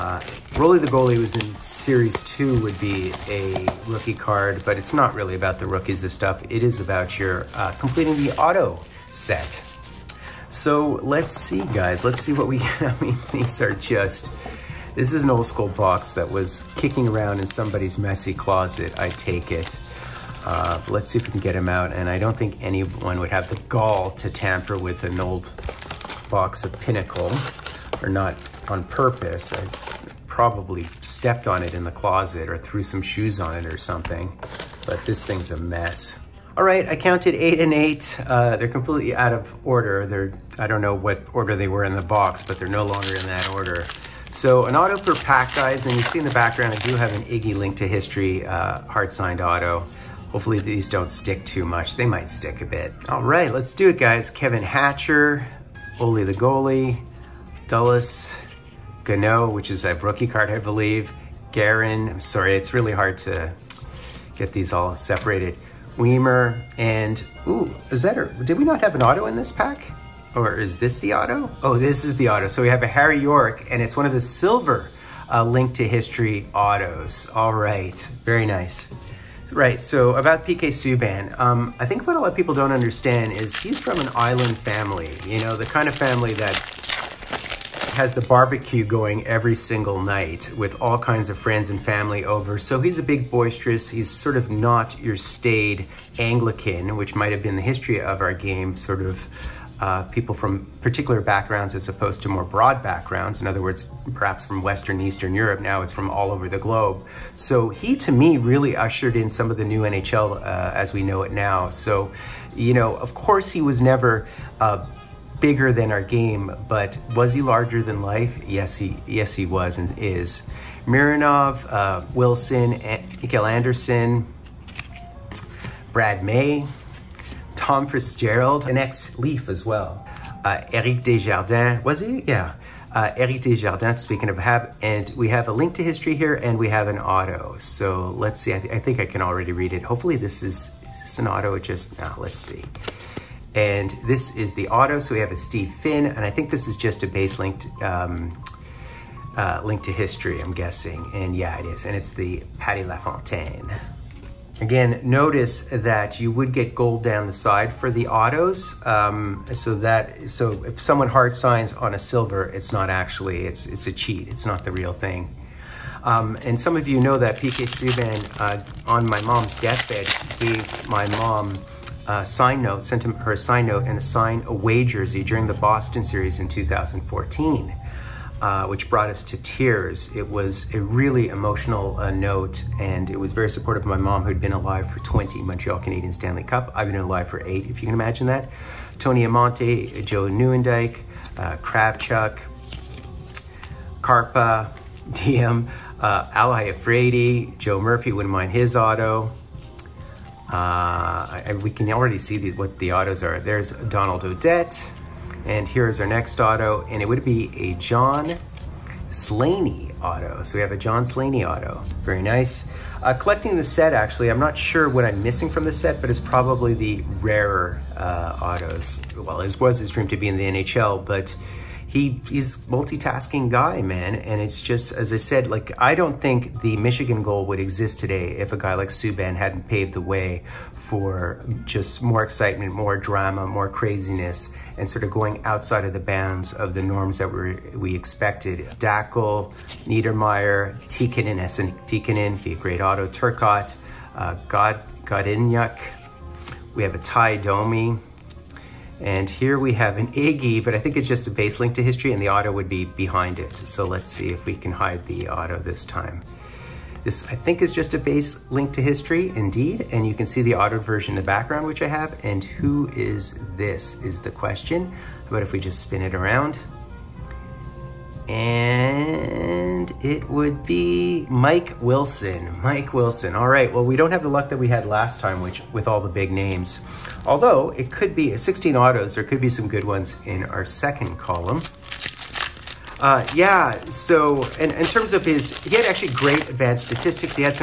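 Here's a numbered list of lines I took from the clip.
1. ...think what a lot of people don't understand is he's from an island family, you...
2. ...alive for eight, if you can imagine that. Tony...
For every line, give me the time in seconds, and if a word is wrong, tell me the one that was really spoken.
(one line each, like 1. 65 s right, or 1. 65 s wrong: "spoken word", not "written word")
1. 81 s right
2. 186 s right.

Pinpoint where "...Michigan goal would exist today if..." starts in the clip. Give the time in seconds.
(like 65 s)
226 s.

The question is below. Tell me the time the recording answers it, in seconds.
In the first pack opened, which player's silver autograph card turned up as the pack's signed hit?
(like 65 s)
72 s.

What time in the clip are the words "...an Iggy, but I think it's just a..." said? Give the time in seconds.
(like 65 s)
249 s.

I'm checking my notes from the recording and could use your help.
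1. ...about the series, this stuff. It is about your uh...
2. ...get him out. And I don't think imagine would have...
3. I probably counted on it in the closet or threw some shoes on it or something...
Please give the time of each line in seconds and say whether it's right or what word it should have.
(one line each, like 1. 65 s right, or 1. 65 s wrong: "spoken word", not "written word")
1. 5 s wrong: "rookies", not "series"
2. 21 s wrong: "anyone", not "imagine"
3. 29 s wrong: "stepped", not "counted".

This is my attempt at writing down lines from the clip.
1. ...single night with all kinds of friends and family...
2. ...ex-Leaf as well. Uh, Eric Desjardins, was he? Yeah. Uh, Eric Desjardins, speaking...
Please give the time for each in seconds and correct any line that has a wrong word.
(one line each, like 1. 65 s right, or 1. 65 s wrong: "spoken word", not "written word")
1. 89 s right
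2. 128 s right.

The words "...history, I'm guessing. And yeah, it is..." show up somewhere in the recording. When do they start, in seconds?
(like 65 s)
149 s.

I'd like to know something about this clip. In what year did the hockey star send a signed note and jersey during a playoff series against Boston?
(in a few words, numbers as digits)
2014.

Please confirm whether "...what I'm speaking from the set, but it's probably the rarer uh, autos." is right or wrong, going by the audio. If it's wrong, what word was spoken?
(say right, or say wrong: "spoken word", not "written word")
wrong: "missing", not "speaking".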